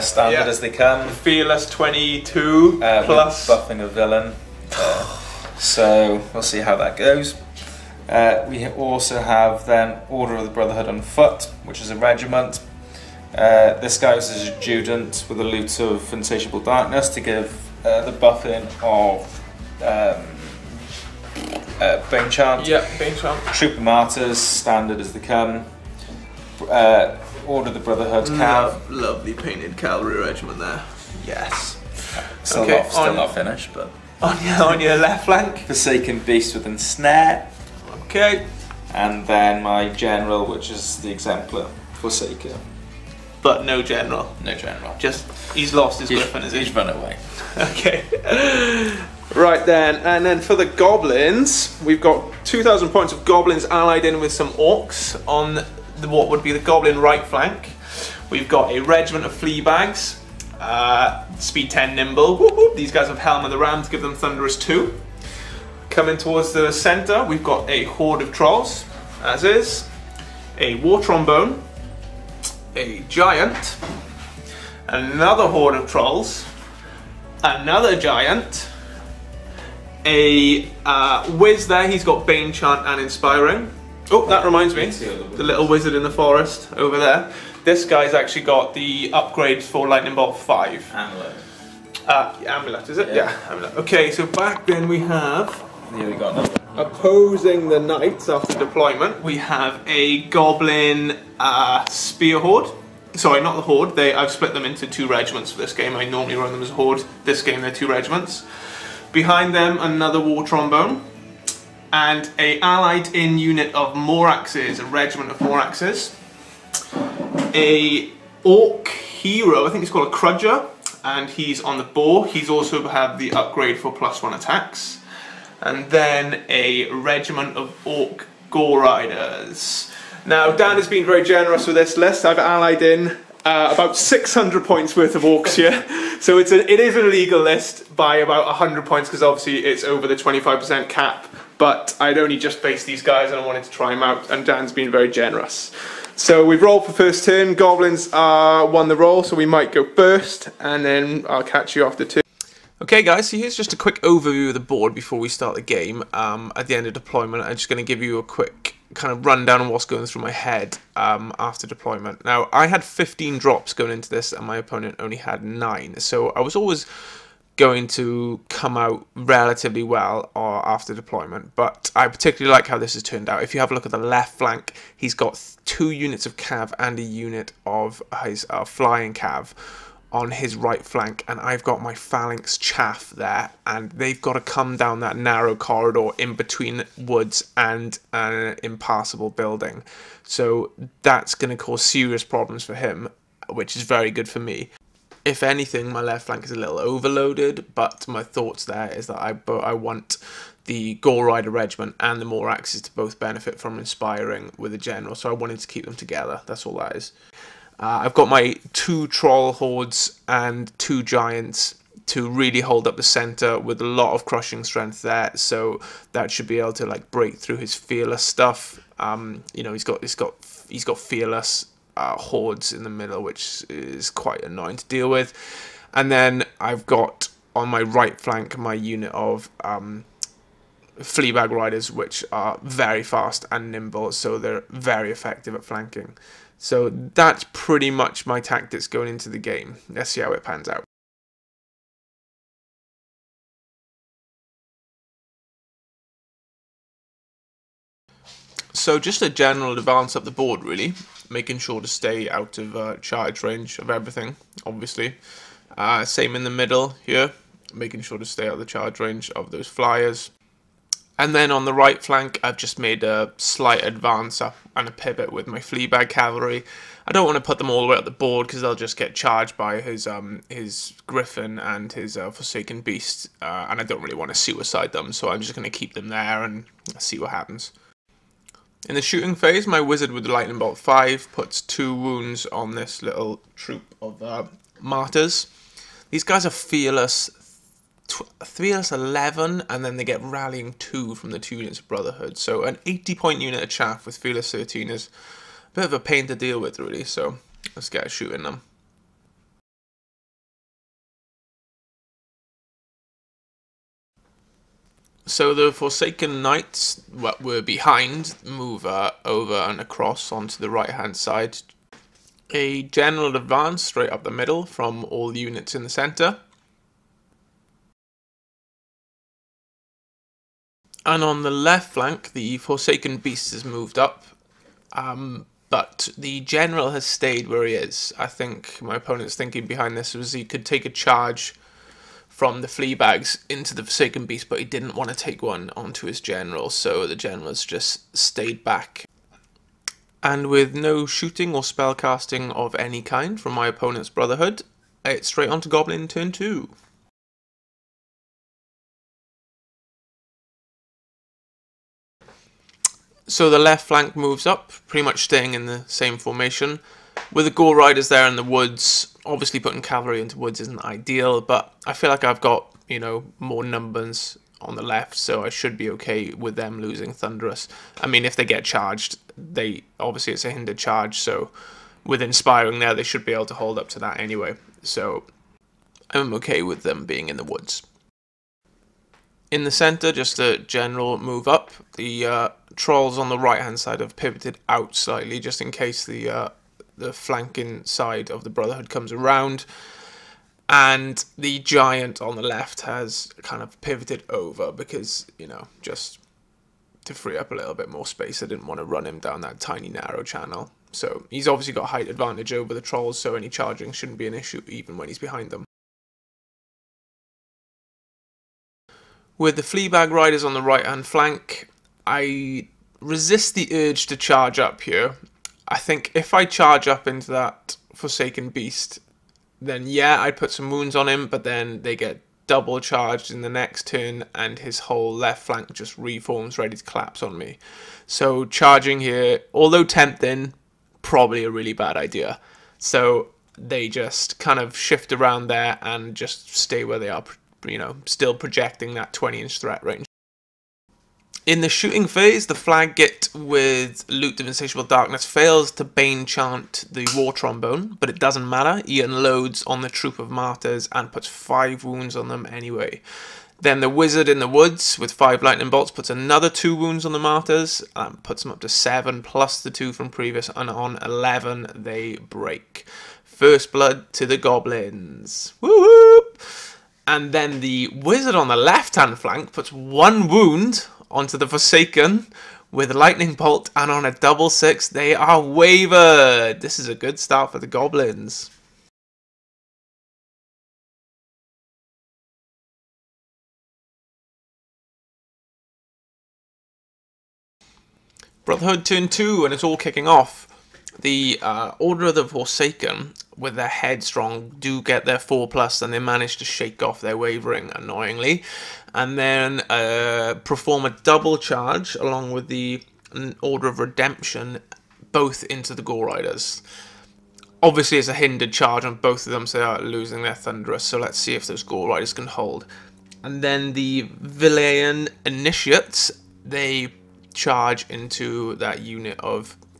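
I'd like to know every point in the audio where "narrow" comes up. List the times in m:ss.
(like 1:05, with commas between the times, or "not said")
3:05, 6:39.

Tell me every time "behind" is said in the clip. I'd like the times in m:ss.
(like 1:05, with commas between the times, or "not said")
1:49, 5:07, 5:29, 6:45.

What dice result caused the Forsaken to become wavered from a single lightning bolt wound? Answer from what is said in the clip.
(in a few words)
Double six.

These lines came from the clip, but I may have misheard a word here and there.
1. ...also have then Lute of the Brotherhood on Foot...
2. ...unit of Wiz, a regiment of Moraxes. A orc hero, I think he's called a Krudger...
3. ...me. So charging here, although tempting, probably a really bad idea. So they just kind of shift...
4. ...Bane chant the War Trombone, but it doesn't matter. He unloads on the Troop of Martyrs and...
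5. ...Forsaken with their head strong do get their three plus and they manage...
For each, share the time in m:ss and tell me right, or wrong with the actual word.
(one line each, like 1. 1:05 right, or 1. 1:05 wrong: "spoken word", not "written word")
1. 0:08 wrong: "Order", not "Lute"
2. 1:53 wrong: "Moraxes", not "Wiz"
3. 7:07 right
4. 7:25 right
5. 8:12 wrong: "four", not "three".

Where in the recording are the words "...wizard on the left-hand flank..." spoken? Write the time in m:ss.
7:47.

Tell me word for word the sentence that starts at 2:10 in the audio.
Now, Dan has been very generous with this list.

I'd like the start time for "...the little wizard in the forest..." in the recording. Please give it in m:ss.
1:24.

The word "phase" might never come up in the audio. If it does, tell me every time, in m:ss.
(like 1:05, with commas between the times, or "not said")
4:39, 7:22.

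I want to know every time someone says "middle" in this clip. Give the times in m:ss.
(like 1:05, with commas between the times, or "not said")
3:42, 4:16, 5:14.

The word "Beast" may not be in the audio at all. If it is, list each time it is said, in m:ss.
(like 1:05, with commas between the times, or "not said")
0:36, 4:32, 5:23, 5:34, 6:58.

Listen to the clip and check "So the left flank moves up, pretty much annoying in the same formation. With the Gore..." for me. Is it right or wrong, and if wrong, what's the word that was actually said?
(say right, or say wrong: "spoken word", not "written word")
wrong: "staying", not "annoying".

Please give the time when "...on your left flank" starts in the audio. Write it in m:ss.
0:34.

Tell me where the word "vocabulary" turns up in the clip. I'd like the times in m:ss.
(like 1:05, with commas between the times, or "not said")
not said.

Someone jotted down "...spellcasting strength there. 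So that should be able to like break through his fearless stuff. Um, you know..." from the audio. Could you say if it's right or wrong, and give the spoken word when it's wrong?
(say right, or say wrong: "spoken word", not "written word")
wrong: "crushing", not "spellcasting".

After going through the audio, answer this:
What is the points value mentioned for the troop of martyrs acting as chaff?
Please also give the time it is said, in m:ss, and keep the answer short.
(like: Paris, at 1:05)
80, at 4:52.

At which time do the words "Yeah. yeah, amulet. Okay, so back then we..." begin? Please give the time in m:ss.
1:33.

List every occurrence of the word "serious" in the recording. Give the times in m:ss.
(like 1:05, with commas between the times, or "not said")
3:11.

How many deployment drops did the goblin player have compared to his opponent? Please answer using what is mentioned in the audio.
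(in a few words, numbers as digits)
15.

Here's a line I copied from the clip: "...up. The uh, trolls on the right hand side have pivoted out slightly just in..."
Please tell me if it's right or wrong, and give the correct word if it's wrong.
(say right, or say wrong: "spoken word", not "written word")
right.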